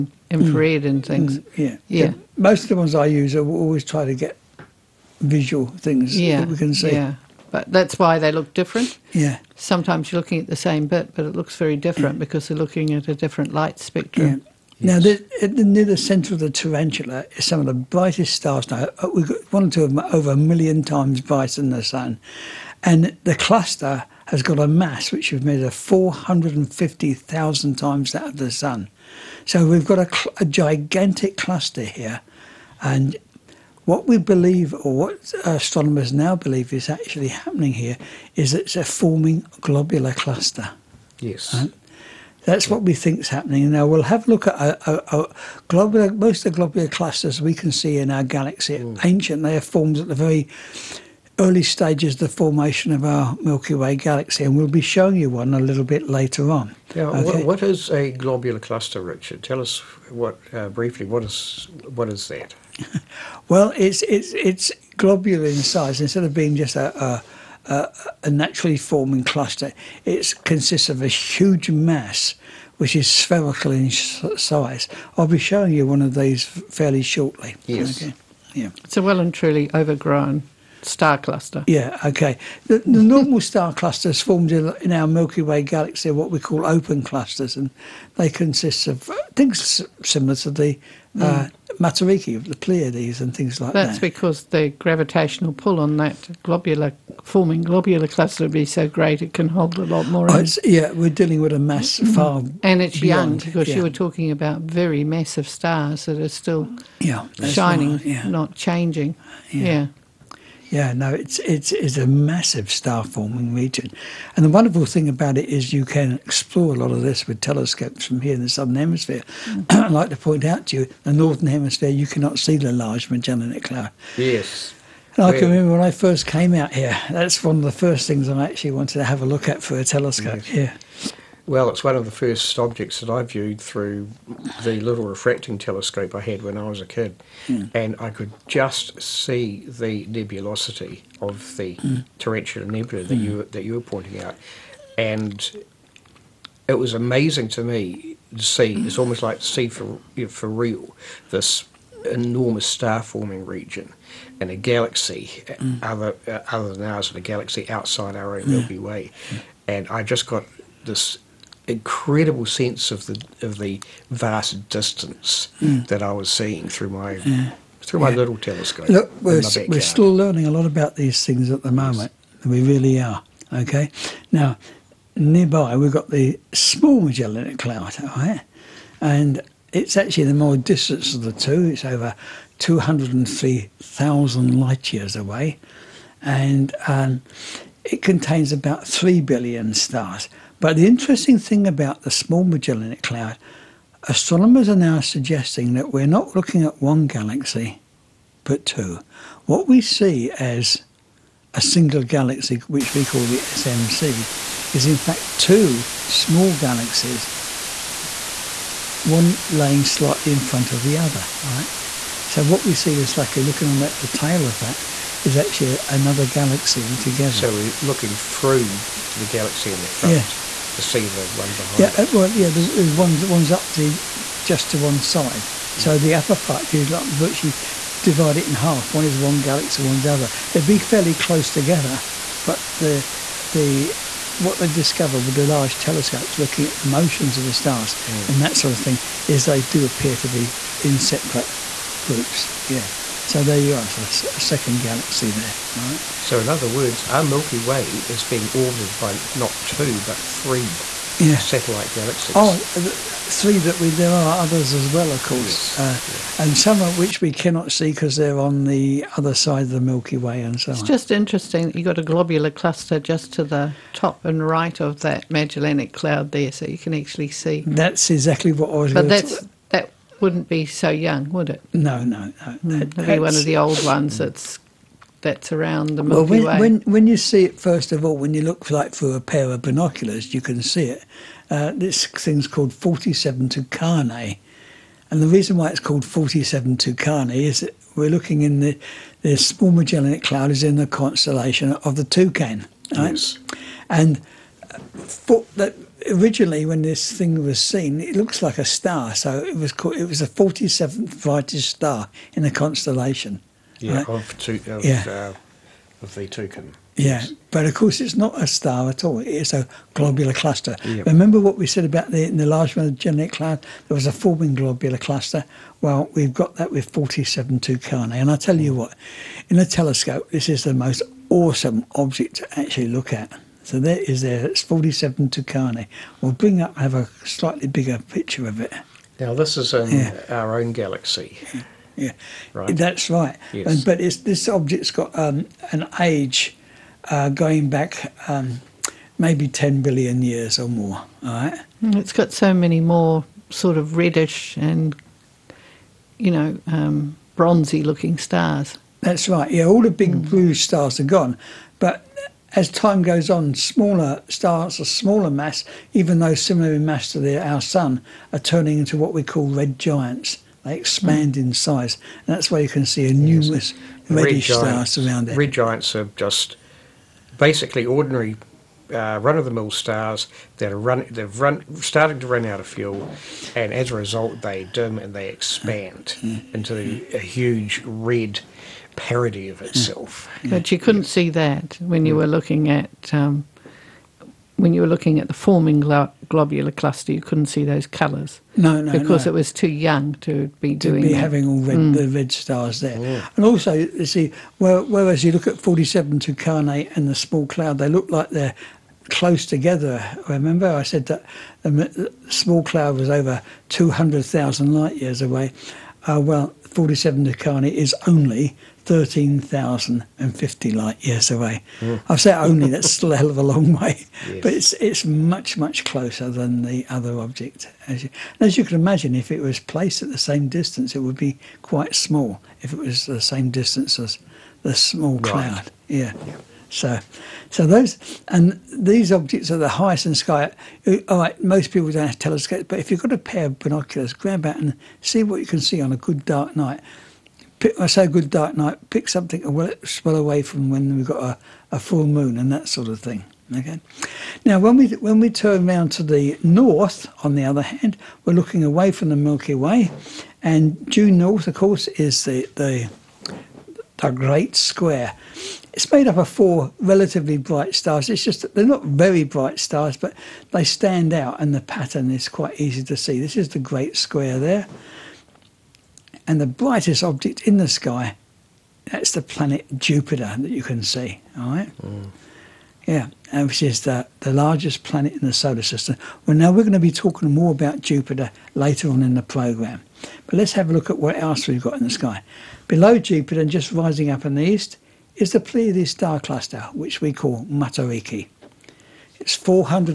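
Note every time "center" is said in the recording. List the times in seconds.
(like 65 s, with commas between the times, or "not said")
15 s.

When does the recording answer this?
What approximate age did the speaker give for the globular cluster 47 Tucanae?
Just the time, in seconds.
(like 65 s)
339 s.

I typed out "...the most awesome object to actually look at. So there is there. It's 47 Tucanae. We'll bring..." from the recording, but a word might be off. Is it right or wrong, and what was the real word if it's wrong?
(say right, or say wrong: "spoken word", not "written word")
right.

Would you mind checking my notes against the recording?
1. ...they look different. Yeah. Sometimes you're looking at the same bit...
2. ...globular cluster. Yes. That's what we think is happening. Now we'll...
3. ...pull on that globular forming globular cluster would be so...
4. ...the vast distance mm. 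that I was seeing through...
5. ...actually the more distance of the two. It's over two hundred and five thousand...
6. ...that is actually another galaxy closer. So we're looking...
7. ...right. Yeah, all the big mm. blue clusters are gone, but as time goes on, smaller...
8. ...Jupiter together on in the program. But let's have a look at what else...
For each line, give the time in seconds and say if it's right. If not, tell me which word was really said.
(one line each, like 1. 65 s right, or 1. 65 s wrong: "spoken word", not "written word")
1. 8 s right
2. 39 s right
3. 95 s right
4. 163 s right
5. 179 s wrong: "three", not "five"
6. 214 s wrong: "altogether", not "closer"
7. 349 s wrong: "stars", not "clusters"
8. 477 s wrong: "later", not "together".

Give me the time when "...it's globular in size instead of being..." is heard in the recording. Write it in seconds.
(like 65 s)
64 s.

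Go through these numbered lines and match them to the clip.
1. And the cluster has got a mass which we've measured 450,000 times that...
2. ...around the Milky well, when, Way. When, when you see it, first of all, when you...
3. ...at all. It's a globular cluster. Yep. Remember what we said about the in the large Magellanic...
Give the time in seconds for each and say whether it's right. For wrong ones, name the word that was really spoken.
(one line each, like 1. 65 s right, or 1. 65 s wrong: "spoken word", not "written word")
1. 22 s right
2. 275 s right
3. 308 s right.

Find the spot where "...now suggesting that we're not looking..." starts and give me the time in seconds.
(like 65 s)
194 s.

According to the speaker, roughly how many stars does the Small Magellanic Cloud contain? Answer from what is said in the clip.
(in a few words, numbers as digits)
3 billion.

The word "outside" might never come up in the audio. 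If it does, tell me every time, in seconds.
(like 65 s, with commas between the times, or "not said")
157 s.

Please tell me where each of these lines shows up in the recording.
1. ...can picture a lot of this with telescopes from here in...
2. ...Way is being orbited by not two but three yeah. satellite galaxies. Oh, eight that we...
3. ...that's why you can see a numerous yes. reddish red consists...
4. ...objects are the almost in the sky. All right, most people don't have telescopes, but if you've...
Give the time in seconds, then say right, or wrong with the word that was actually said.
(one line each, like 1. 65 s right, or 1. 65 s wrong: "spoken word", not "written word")
1. 115 s wrong: "explore", not "picture"
2. 247 s wrong: "three", not "eight"
3. 362 s wrong: "giants", not "consists"
4. 429 s wrong: "highest", not "almost".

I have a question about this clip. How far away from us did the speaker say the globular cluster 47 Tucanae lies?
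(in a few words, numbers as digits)
13,050 light years.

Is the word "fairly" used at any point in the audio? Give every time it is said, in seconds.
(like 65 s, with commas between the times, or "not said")
76 s, 230 s.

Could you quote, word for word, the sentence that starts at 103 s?
you were talking about very massive stars that are still yeah, shining, right, yeah.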